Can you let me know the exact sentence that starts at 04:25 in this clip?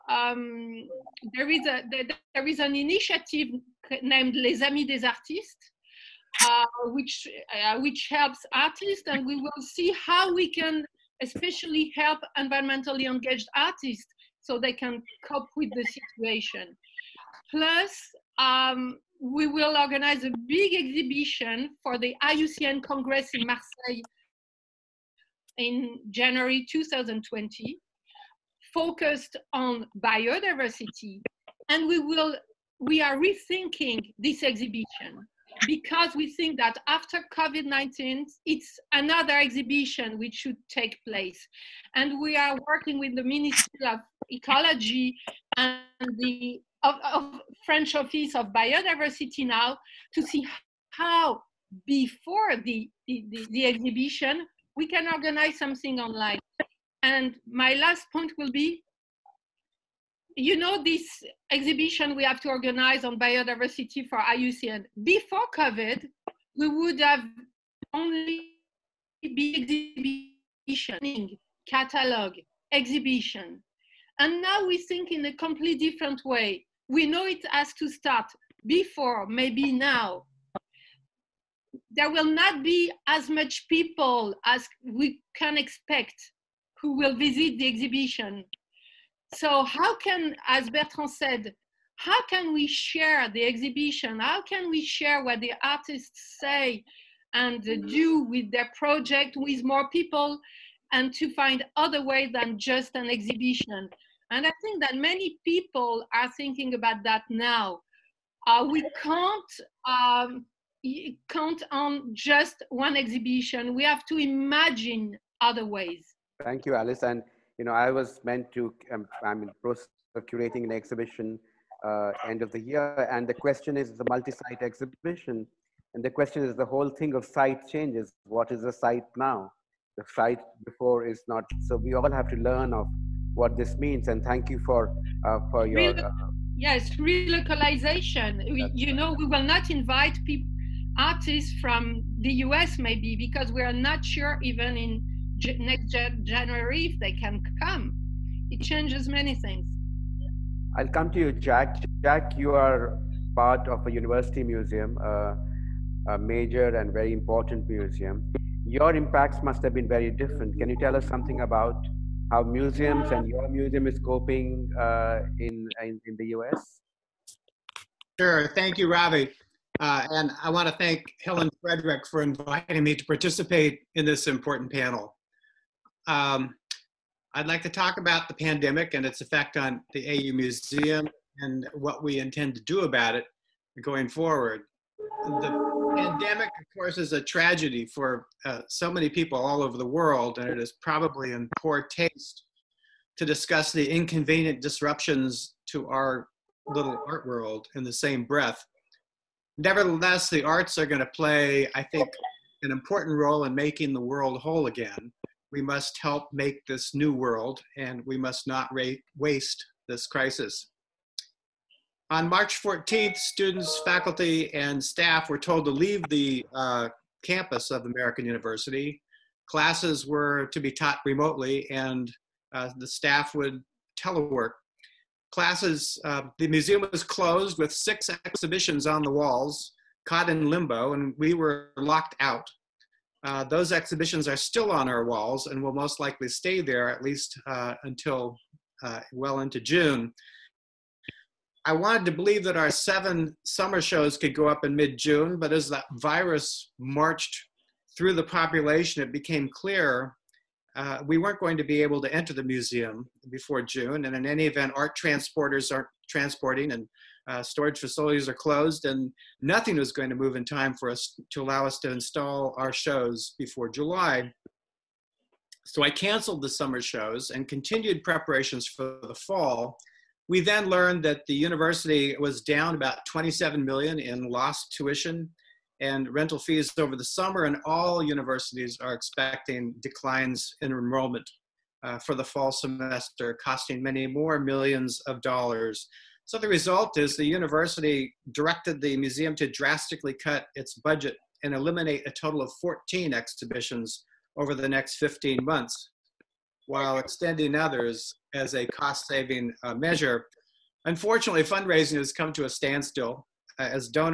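So I canceled the summer shows and continued preparations for the fall.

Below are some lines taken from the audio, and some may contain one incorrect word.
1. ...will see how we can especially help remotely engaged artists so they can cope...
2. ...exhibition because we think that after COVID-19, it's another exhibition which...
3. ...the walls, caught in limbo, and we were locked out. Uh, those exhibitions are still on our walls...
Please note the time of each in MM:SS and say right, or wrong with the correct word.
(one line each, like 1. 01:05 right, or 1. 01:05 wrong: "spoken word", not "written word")
1. 00:09 wrong: "environmentally", not "remotely"
2. 00:34 right
3. 03:49 right.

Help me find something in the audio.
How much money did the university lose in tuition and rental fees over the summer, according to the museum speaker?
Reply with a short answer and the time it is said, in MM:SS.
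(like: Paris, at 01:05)
27 million, at 04:33.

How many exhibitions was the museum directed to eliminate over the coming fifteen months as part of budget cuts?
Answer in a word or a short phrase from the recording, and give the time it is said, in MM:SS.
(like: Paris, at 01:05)
14, at 04:52.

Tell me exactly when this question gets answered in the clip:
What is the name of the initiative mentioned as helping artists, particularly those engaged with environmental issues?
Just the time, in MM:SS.
00:04.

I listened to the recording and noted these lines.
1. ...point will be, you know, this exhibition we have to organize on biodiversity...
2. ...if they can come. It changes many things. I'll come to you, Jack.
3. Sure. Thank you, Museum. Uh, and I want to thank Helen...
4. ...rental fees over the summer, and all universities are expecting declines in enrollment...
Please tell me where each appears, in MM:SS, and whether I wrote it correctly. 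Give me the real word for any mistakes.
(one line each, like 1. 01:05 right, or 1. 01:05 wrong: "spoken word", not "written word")
1. 00:58 right
2. 02:26 right
3. 02:48 wrong: "Ravi", not "Museum"
4. 04:36 right.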